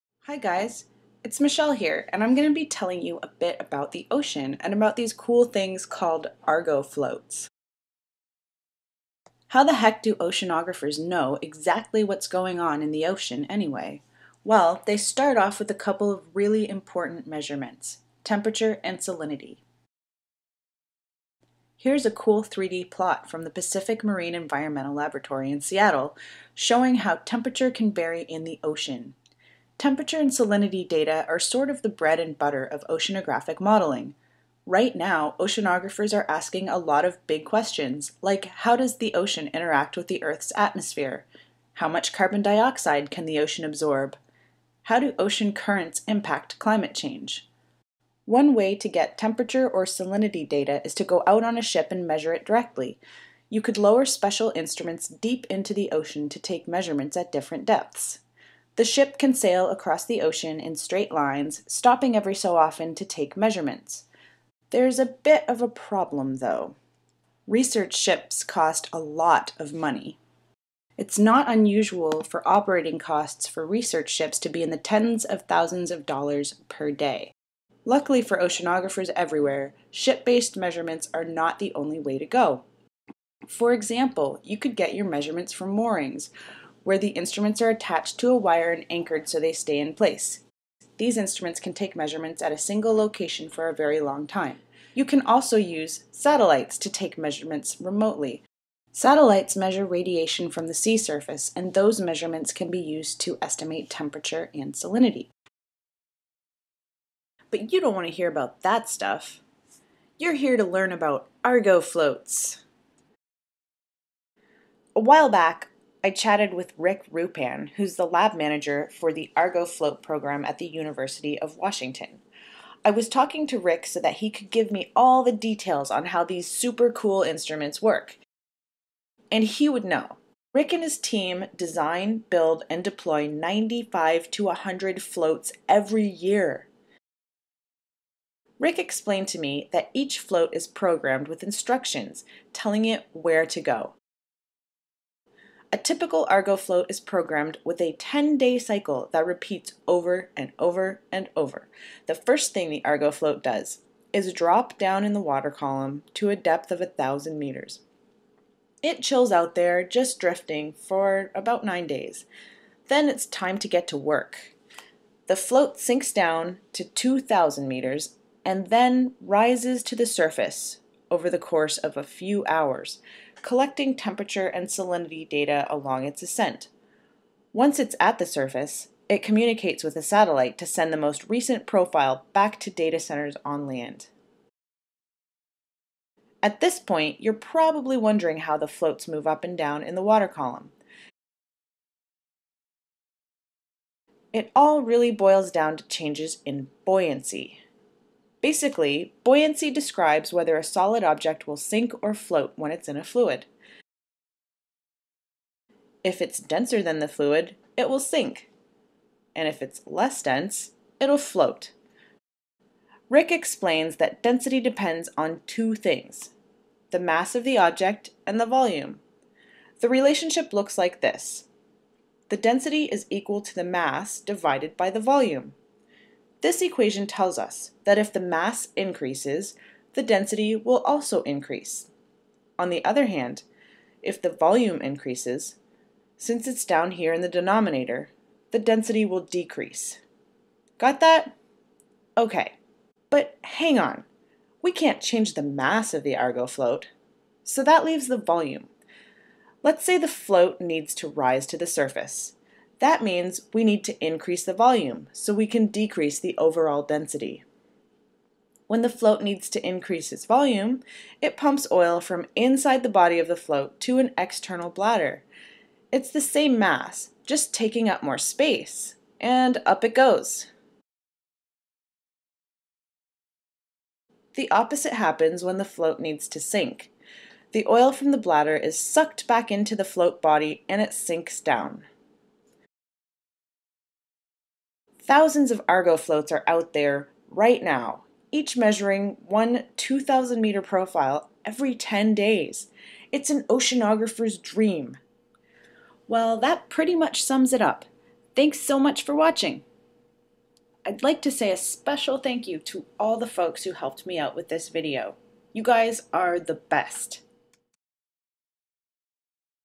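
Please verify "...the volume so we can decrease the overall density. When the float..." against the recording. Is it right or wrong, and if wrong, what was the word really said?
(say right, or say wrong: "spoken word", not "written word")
right.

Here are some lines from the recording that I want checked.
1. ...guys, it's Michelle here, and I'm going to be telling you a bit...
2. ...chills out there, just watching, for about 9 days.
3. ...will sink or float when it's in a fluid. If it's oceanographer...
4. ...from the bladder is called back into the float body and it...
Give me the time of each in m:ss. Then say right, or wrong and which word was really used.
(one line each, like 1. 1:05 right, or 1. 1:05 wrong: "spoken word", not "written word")
1. 0:00 right
2. 2:39 wrong: "drifting", not "watching"
3. 3:21 wrong: "denser", not "oceanographer"
4. 4:37 wrong: "sucked", not "called".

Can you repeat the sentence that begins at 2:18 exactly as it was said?
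Rick explained to me that each float is programmed with instructions telling it where to go.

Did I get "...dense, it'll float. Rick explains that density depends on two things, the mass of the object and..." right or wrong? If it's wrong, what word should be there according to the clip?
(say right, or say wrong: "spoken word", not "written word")
right.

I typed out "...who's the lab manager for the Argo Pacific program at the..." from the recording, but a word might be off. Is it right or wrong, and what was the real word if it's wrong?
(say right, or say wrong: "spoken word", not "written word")
wrong: "Float", not "Pacific".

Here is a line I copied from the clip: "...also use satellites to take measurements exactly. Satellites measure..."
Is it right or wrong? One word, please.
wrong.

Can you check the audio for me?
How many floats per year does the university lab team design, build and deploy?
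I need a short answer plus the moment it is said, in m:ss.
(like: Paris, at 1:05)
95 to 100, at 2:13.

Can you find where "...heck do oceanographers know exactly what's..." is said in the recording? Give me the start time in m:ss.
0:09.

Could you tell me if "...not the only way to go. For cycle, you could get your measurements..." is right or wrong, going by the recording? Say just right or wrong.
wrong.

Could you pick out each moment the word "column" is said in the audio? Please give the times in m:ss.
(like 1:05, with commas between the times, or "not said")
2:35, 3:10.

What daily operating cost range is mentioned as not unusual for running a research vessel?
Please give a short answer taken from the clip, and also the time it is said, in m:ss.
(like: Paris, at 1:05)
tens of thousands of dollars, at 1:14.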